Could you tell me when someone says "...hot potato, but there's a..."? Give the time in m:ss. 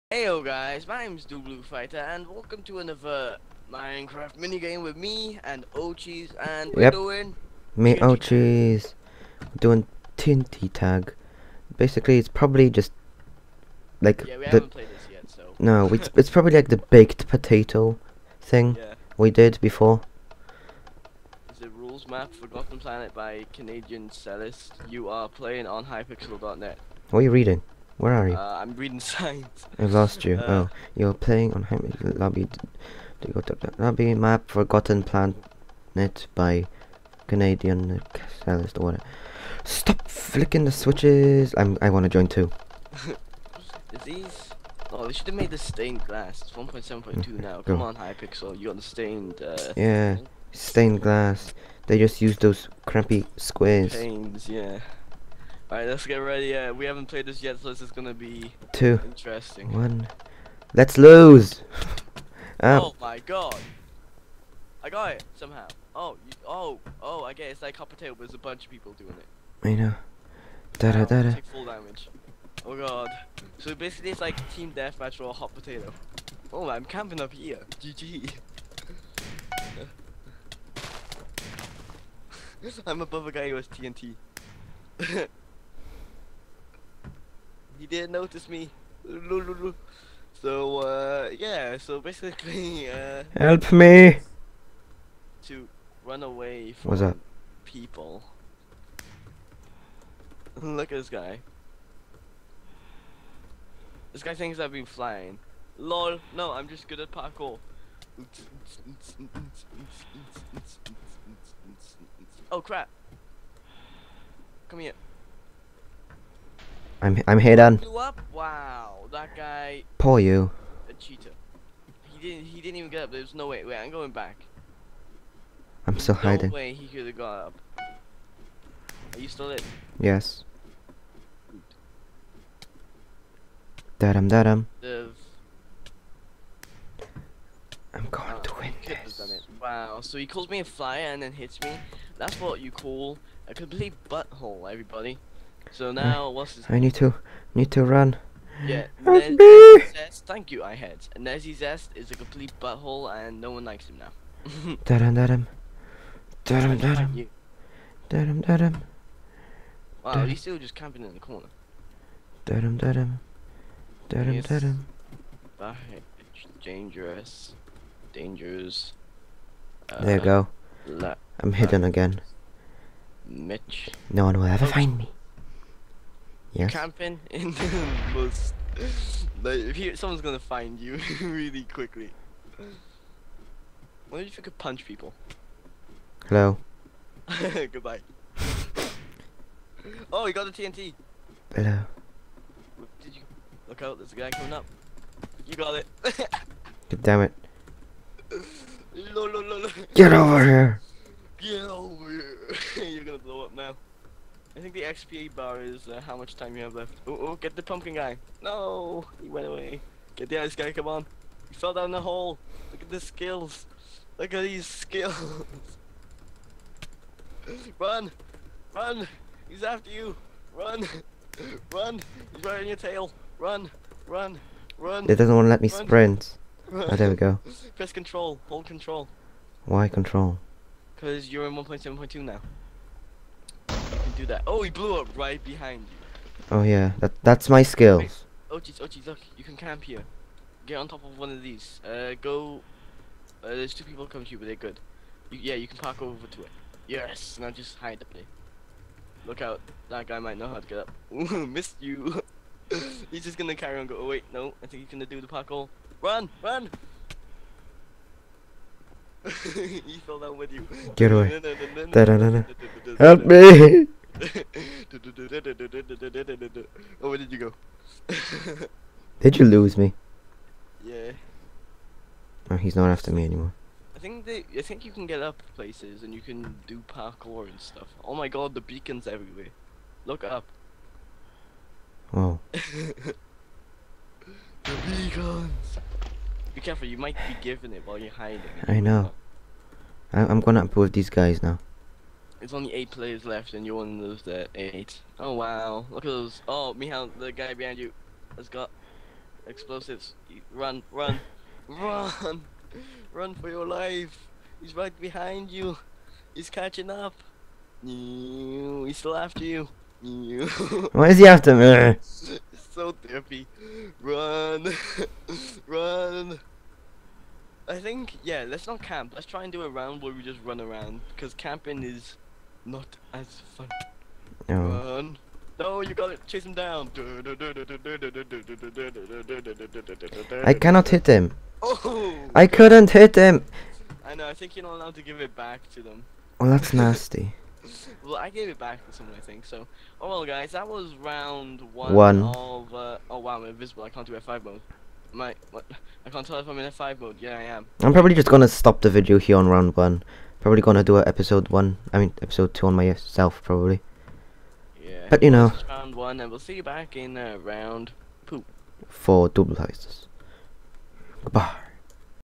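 1:07.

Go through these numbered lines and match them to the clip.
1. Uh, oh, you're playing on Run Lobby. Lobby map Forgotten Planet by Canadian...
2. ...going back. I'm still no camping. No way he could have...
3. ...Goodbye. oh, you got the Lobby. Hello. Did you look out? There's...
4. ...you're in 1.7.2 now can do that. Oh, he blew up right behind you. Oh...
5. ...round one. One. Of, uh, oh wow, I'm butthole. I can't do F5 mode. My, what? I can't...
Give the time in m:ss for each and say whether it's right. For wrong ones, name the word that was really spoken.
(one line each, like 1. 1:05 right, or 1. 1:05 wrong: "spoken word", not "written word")
1. 0:30 wrong: "Hamid", not "Run"
2. 2:03 wrong: "hiding", not "camping"
3. 3:07 wrong: "TNT", not "Lobby"
4. 3:51 right
5. 5:40 wrong: "invisible", not "butthole".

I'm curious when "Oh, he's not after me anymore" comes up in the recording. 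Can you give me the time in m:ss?
4:32.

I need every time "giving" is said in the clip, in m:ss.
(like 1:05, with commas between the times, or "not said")
4:47.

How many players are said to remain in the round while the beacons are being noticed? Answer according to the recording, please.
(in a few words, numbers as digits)
8.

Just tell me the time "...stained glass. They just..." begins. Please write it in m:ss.
0:50.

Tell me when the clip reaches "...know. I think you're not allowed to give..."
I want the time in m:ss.
5:34.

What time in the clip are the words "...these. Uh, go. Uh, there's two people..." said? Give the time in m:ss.
4:01.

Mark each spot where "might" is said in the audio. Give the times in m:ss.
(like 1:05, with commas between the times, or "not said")
4:10, 4:46.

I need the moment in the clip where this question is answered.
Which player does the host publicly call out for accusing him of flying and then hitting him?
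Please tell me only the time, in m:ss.
2:31.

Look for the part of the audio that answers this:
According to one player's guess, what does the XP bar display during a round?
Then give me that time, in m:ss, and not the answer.
3:26.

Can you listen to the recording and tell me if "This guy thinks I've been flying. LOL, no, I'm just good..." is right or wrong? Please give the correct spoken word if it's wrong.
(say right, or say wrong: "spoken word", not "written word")
right.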